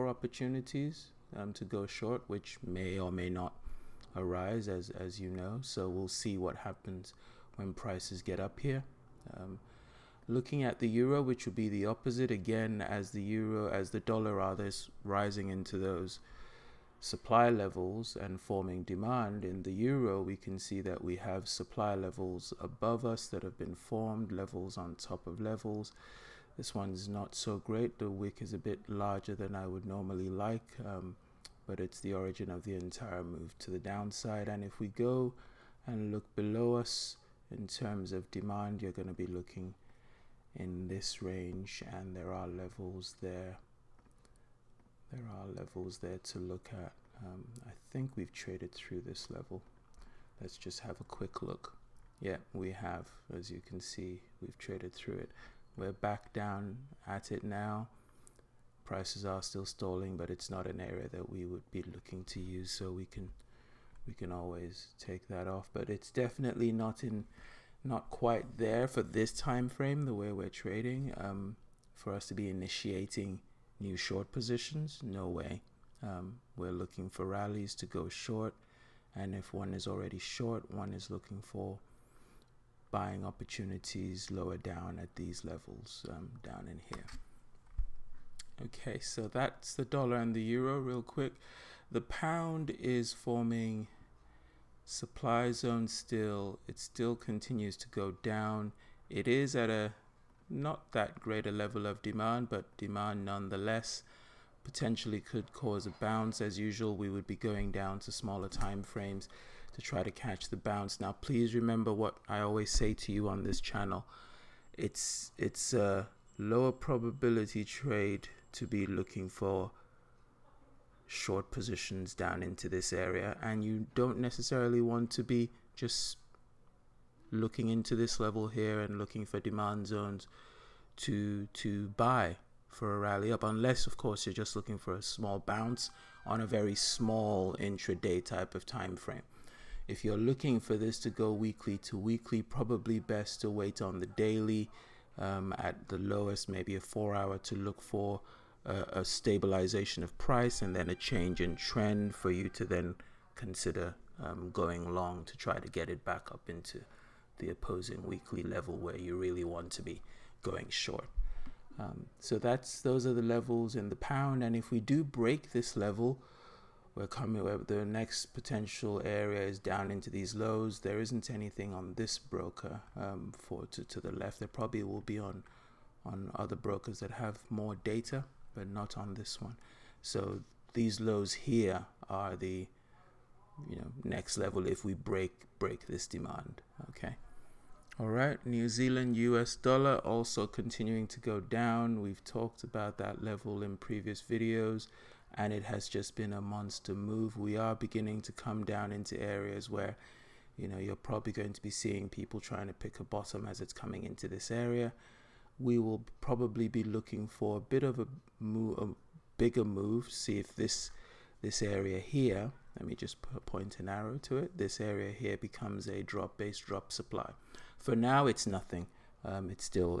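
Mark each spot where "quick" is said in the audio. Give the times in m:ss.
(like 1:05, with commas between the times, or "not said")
0:51, 1:31.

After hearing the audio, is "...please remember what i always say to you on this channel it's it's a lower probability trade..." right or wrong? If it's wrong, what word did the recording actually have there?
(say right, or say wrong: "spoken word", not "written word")
right.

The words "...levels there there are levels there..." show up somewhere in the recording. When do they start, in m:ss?
0:42.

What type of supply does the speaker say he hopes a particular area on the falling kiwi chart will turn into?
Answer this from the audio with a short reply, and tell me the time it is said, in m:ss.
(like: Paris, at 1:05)
Drop based drop supply, at 3:36.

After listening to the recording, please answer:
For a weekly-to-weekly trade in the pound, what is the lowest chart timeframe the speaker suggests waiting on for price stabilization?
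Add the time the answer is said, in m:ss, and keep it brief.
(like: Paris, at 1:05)
Four hour, at 2:26.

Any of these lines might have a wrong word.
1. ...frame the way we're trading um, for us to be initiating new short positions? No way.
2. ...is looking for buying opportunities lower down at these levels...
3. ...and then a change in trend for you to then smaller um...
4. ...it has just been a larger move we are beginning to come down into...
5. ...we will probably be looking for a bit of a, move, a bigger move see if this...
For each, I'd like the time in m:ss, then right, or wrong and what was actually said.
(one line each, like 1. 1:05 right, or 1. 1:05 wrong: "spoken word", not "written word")
1. 1:09 right
2. 1:20 right
3. 2:30 wrong: "consider", not "smaller"
4. 3:15 wrong: "monster", not "larger"
5. 3:25 right.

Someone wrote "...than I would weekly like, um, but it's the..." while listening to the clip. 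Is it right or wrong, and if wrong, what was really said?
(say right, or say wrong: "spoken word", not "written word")
wrong: "normally", not "weekly".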